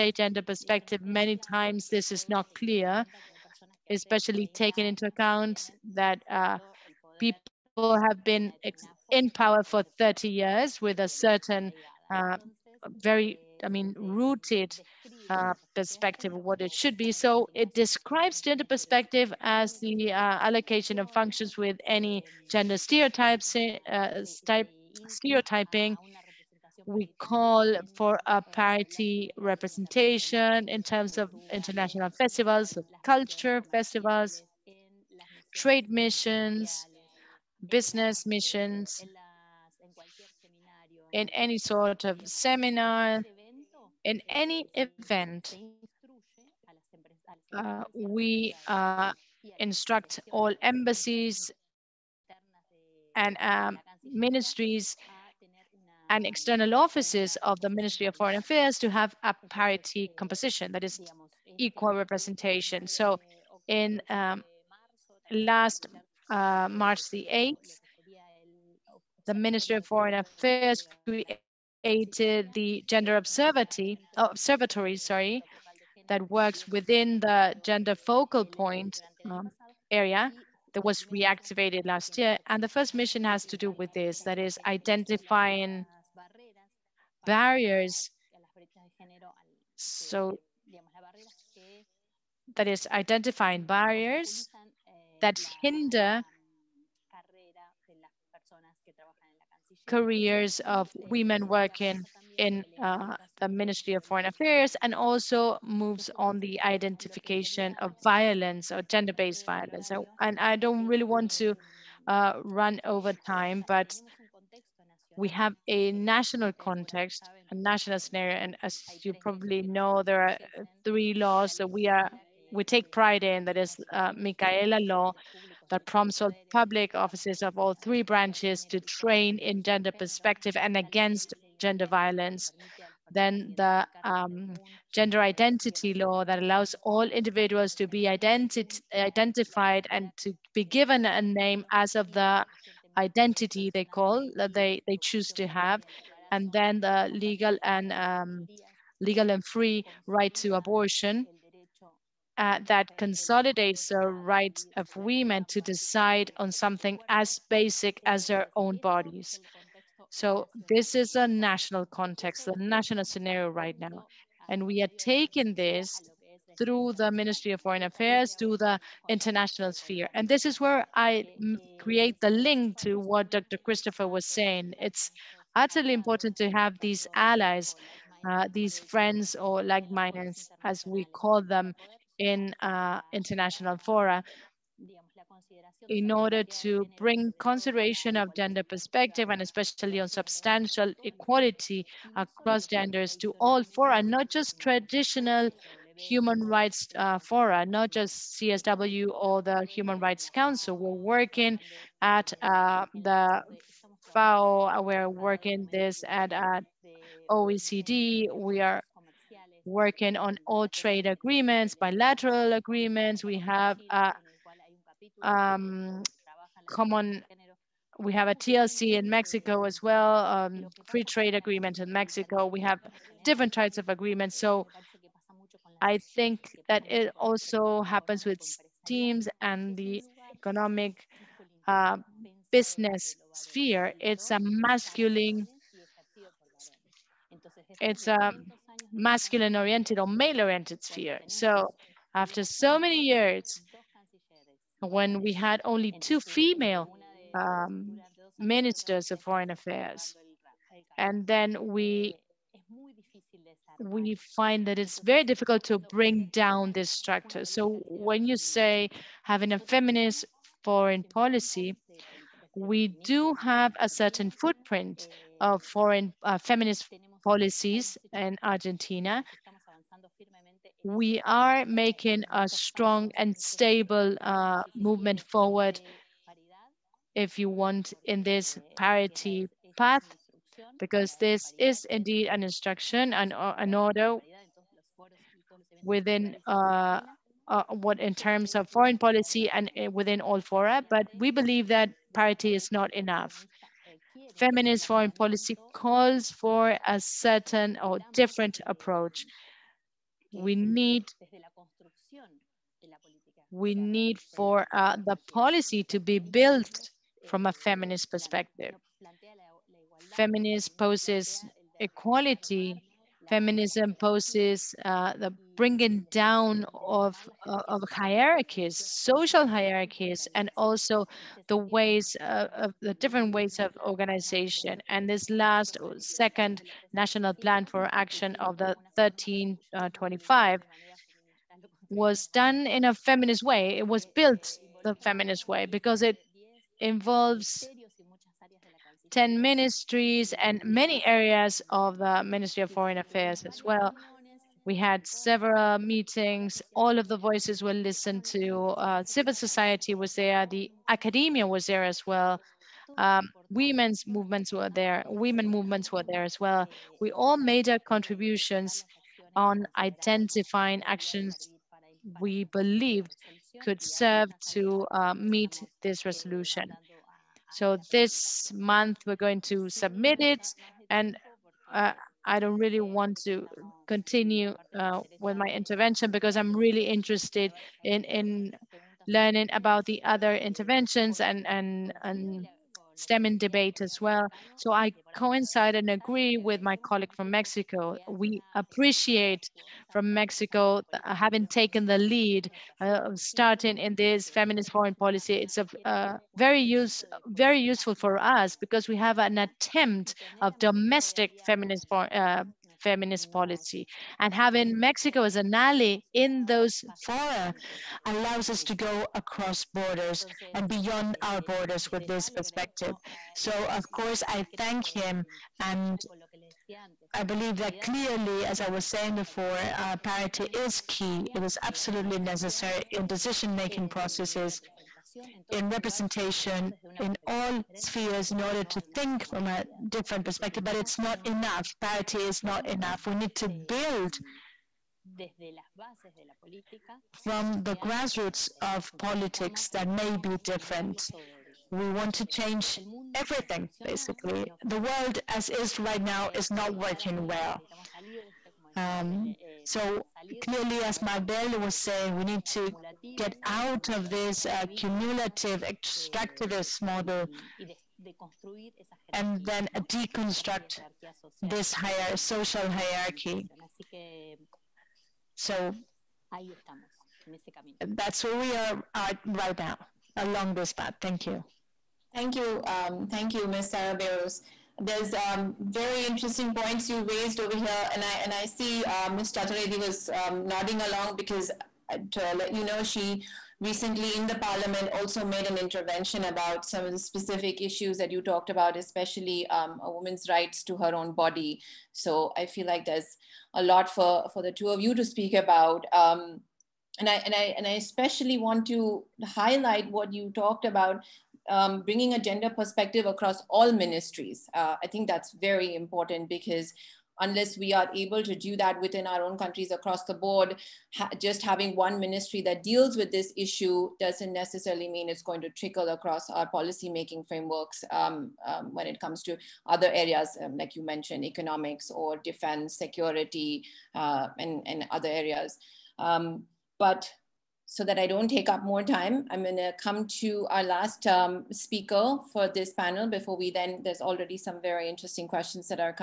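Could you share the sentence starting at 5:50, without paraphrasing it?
The academia was there as well.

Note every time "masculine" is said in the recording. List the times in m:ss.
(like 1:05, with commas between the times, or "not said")
3:54, 3:58.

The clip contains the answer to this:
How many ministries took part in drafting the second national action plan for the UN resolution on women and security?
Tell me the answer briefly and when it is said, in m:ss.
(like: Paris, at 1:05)
10, at 5:39.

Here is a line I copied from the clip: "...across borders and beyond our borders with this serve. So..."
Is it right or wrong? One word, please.
wrong.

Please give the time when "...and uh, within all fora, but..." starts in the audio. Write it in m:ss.
4:49.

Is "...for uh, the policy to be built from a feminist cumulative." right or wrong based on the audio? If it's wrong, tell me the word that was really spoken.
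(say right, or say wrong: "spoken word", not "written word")
wrong: "perspective", not "cumulative".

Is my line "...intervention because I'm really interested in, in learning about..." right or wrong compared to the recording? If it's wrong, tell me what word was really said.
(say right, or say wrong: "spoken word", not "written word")
right.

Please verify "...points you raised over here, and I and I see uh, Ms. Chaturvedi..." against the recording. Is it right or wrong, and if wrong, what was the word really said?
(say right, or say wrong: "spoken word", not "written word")
right.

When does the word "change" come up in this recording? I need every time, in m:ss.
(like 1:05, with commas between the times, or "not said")
7:22.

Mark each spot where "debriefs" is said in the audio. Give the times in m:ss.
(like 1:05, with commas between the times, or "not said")
not said.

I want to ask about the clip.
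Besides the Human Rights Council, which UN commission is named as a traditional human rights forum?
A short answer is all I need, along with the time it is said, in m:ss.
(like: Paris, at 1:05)
CSW, at 3:18.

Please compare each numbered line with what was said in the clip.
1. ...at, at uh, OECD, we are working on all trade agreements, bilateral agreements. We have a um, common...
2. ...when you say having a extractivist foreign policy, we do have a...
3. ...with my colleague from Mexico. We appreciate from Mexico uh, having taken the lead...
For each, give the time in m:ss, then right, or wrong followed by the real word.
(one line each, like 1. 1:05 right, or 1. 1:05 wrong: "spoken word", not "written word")
1. 3:26 right
2. 4:17 wrong: "feminist", not "extractivist"
3. 6:26 right.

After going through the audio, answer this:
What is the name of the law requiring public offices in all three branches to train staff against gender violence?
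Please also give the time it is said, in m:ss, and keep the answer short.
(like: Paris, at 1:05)
Micaela law, at 2:04.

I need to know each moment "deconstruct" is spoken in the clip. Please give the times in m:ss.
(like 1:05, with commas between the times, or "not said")
7:39.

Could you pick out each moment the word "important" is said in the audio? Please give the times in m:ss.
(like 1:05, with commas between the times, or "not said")
2:55, 8:25.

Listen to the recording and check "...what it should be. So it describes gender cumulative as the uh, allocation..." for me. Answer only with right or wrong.
wrong.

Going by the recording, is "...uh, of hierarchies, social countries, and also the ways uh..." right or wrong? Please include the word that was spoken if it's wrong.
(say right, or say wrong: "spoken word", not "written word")
wrong: "hierarchies", not "countries".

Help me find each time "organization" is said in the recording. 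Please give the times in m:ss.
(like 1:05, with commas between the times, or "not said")
5:23.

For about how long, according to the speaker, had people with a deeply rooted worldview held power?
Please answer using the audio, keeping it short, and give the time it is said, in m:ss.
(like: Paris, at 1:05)
30 years, at 0:09.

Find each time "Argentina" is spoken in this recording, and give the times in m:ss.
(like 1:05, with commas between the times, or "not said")
4:28.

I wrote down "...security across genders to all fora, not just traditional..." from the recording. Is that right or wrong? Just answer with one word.
wrong.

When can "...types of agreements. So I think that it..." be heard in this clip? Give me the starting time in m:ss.
3:43.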